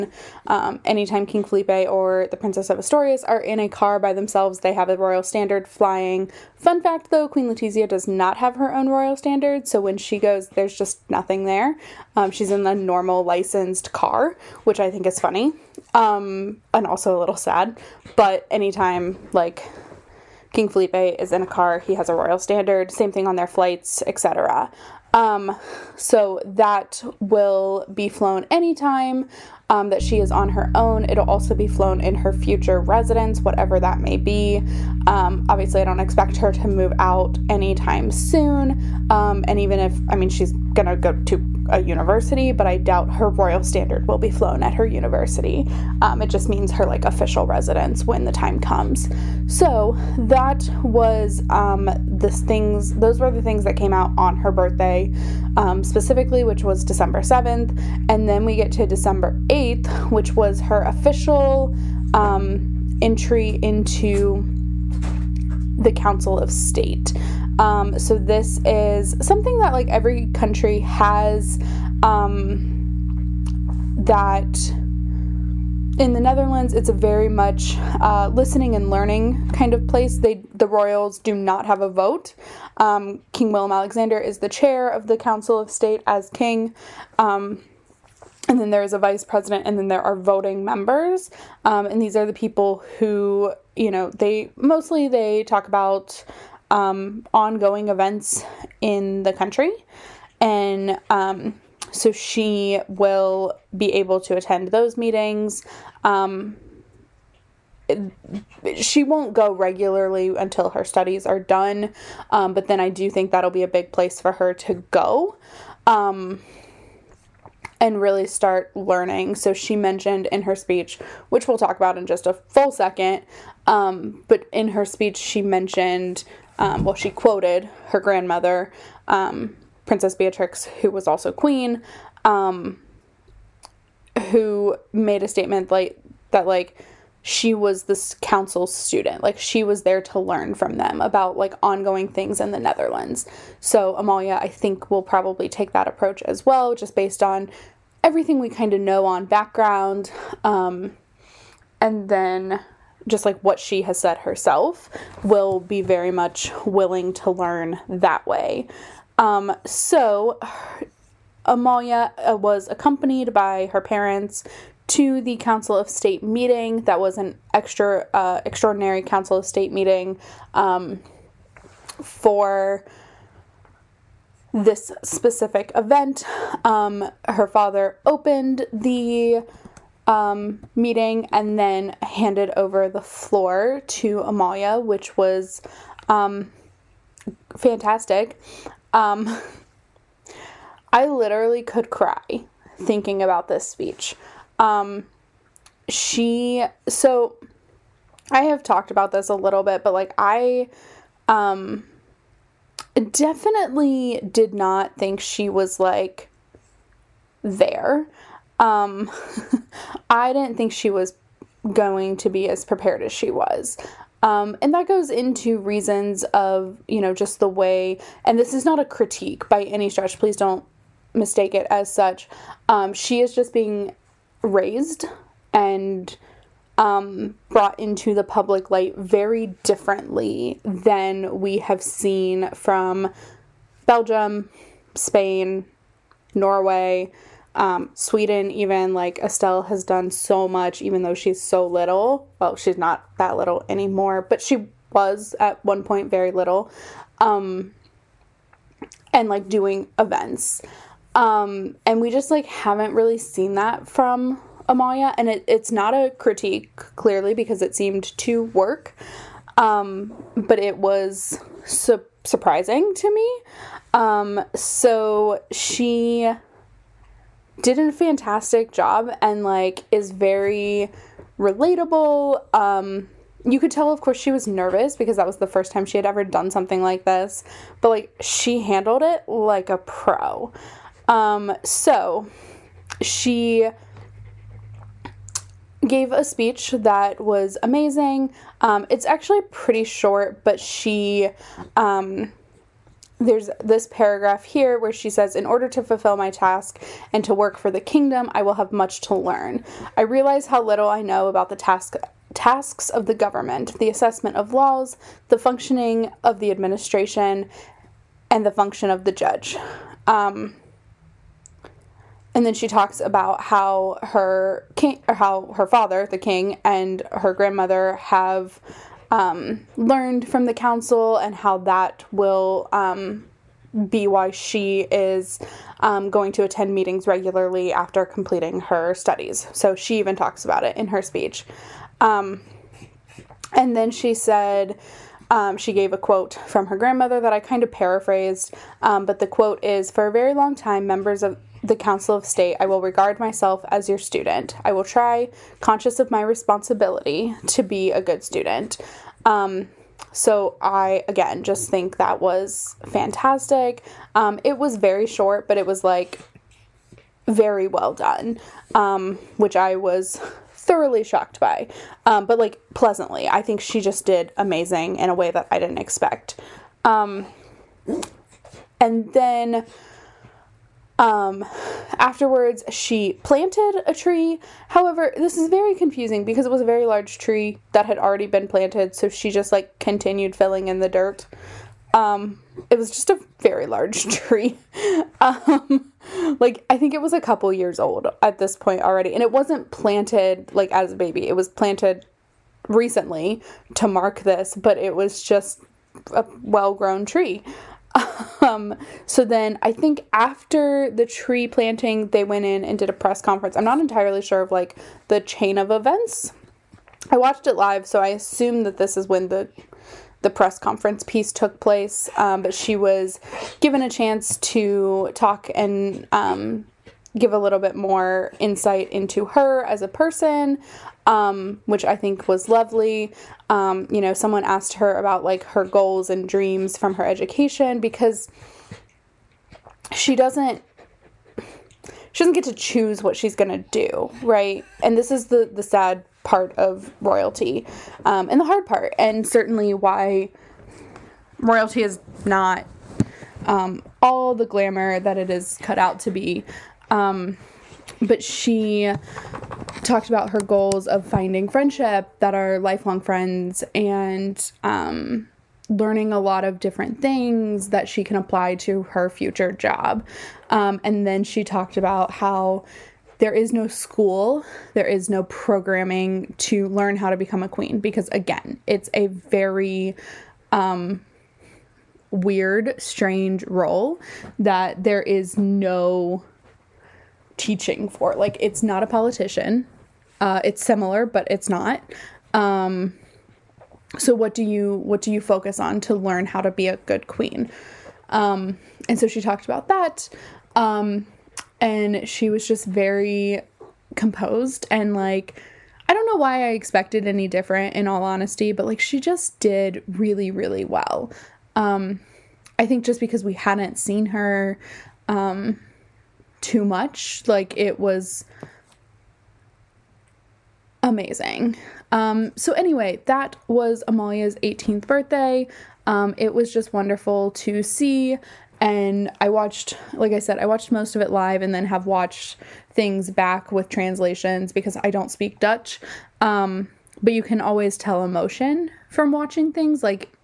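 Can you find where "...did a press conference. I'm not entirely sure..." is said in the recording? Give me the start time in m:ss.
6:42.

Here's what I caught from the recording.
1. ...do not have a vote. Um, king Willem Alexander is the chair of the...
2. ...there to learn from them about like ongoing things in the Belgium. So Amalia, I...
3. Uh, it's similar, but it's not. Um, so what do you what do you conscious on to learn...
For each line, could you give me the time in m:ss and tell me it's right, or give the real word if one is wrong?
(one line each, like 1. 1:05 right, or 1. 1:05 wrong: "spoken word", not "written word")
1. 1:21 right
2. 2:19 wrong: "Netherlands", not "Belgium"
3. 8:00 wrong: "focus", not "conscious".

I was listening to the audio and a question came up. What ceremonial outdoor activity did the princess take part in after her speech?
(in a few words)
planted a tree.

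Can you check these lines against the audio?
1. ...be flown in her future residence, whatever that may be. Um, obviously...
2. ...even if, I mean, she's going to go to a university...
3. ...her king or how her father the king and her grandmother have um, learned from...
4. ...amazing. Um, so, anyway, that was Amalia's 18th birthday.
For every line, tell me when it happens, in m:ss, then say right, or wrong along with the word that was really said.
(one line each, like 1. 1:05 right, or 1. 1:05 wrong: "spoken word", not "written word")
1. 0:31 right
2. 0:39 right
3. 5:14 right
4. 8:30 right.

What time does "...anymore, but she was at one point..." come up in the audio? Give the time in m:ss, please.
4:03.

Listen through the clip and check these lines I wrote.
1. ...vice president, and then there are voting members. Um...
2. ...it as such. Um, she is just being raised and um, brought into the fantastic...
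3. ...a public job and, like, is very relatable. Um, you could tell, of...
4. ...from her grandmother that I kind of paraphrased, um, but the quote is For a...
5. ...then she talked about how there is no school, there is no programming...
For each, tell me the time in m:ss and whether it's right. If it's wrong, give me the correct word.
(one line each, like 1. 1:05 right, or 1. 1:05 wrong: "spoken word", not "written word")
1. 1:28 right
2. 3:41 wrong: "public", not "fantastic"
3. 4:27 wrong: "fantastic", not "public"
4. 5:36 right
5. 7:41 right.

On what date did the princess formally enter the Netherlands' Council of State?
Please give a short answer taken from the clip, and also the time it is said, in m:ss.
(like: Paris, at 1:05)
December 8th, at 0:58.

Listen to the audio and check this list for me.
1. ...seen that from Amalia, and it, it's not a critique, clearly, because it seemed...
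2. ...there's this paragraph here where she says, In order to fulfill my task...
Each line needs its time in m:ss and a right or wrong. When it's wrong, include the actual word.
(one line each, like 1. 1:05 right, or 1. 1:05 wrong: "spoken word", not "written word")
1. 4:13 right
2. 4:53 right.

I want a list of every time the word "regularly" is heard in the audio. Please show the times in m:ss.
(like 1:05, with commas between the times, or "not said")
1:49, 5:27.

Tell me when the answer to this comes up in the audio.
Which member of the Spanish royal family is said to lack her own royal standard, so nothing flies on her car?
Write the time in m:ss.
0:07.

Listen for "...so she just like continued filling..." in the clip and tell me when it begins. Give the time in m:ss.
6:18.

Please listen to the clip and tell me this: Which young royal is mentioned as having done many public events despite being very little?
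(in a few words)
Estelle.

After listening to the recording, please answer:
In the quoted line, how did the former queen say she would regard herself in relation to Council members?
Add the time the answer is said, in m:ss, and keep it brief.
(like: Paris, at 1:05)
as your student, at 5:43.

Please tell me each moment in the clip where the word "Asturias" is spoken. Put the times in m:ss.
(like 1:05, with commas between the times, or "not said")
0:02.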